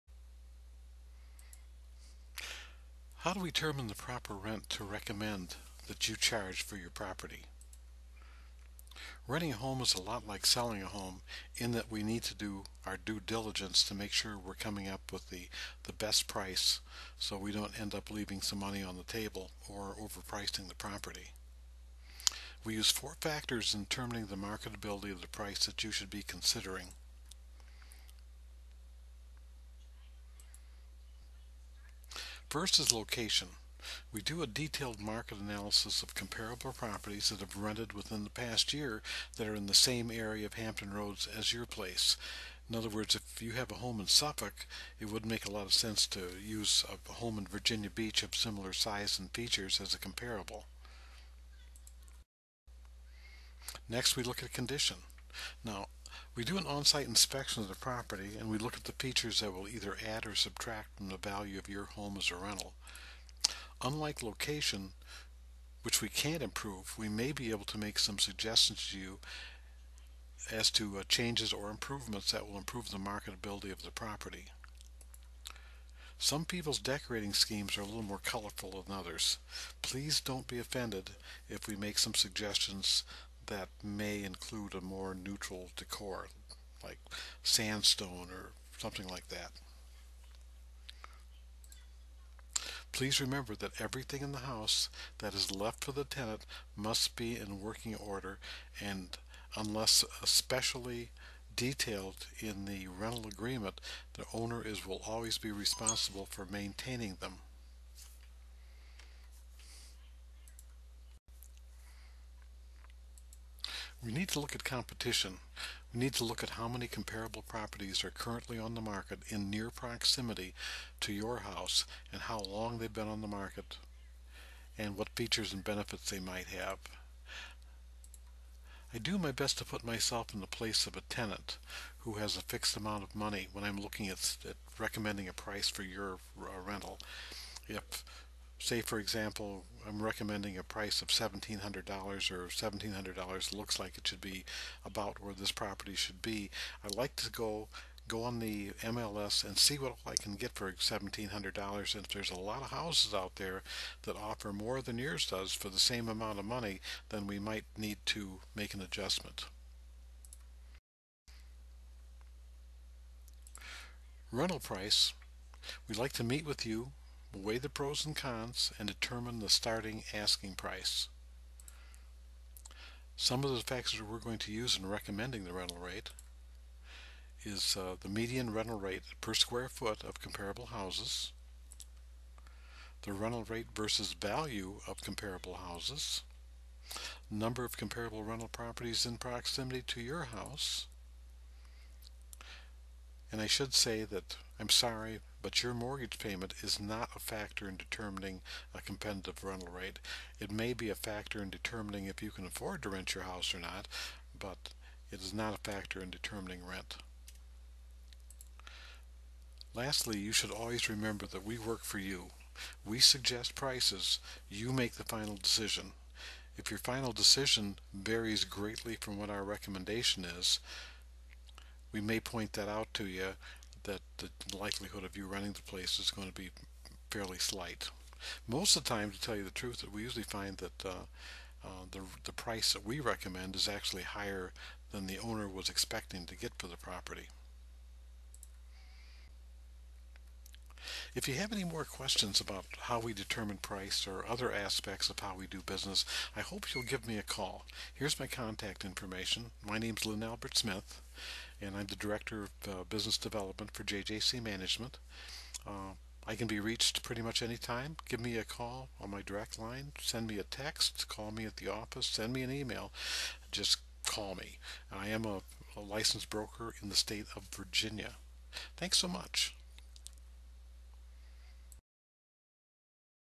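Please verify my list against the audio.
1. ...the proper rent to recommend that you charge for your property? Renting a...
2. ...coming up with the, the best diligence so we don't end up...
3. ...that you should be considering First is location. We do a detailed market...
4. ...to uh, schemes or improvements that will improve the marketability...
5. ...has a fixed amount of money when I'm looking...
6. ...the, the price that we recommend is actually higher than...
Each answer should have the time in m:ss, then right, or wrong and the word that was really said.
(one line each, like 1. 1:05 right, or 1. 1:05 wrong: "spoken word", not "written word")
1. 0:03 right
2. 0:14 wrong: "price", not "diligence"
3. 0:25 right
4. 1:10 wrong: "changes", not "schemes"
5. 2:12 right
6. 3:51 right.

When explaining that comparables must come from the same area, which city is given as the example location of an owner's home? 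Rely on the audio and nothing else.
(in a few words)
Suffolk.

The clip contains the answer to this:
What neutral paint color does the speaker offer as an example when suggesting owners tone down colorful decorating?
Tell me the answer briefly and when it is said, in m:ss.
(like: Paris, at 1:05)
sandstone, at 1:27.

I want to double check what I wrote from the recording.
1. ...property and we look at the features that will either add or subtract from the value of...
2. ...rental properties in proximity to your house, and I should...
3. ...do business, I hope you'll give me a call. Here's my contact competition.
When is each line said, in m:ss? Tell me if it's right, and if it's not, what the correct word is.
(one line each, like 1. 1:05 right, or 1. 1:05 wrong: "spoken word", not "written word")
1. 0:57 right
2. 3:08 right
3. 4:05 wrong: "information", not "competition".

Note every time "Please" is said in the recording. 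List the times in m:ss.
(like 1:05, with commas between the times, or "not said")
1:19, 1:32.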